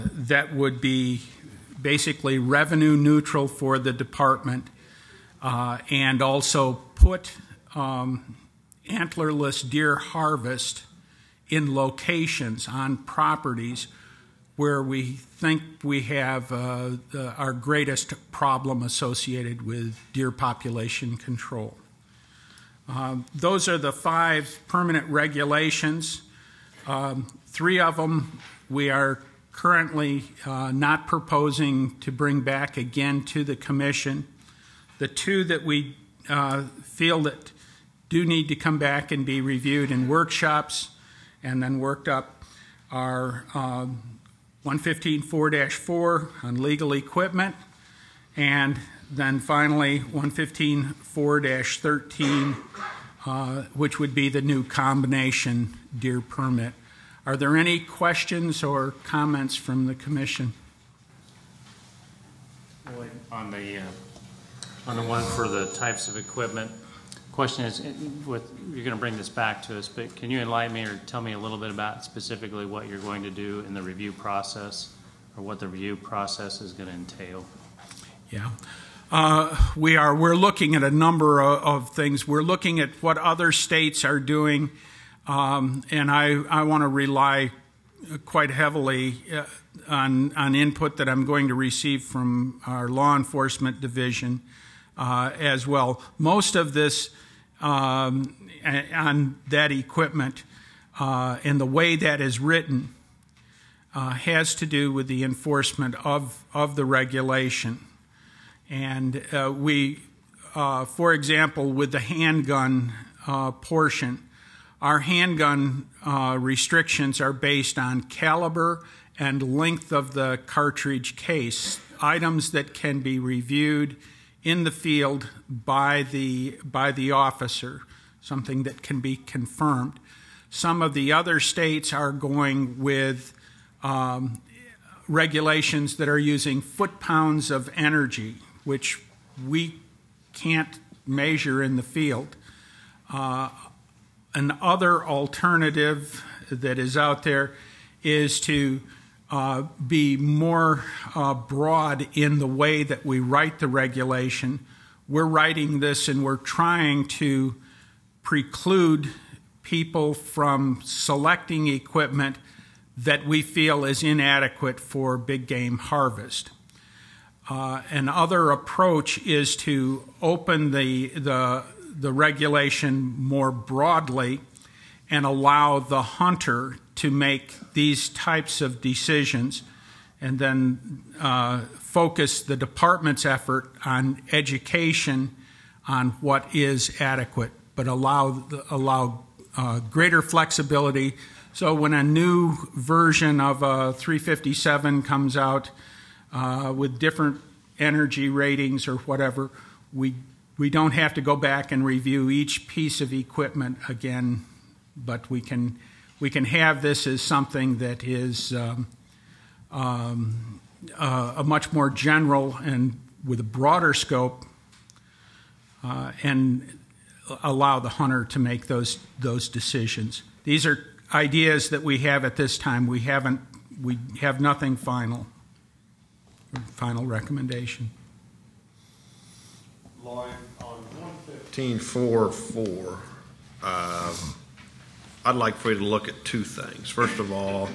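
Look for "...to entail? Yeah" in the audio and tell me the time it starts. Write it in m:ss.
1:16.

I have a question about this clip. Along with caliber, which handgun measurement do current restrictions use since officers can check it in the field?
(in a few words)
length of the cartridge case.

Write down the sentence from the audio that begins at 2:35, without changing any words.
We're writing this and we're trying to preclude people from selecting equipment that we feel is inadequate for big game harvest.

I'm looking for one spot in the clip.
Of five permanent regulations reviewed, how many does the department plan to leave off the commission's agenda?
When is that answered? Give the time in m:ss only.
0:27.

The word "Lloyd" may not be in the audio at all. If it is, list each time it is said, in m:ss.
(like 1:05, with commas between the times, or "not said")
3:50.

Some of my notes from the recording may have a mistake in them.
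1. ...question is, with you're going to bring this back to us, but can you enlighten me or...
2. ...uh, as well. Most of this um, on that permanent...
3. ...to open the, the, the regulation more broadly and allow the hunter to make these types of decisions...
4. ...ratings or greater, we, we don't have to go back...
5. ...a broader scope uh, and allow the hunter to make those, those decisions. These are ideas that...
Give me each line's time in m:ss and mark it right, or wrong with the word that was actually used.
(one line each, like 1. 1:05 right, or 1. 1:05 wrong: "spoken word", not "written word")
1. 1:07 right
2. 1:34 wrong: "equipment", not "permanent"
3. 2:49 right
4. 3:18 wrong: "whatever", not "greater"
5. 3:33 right.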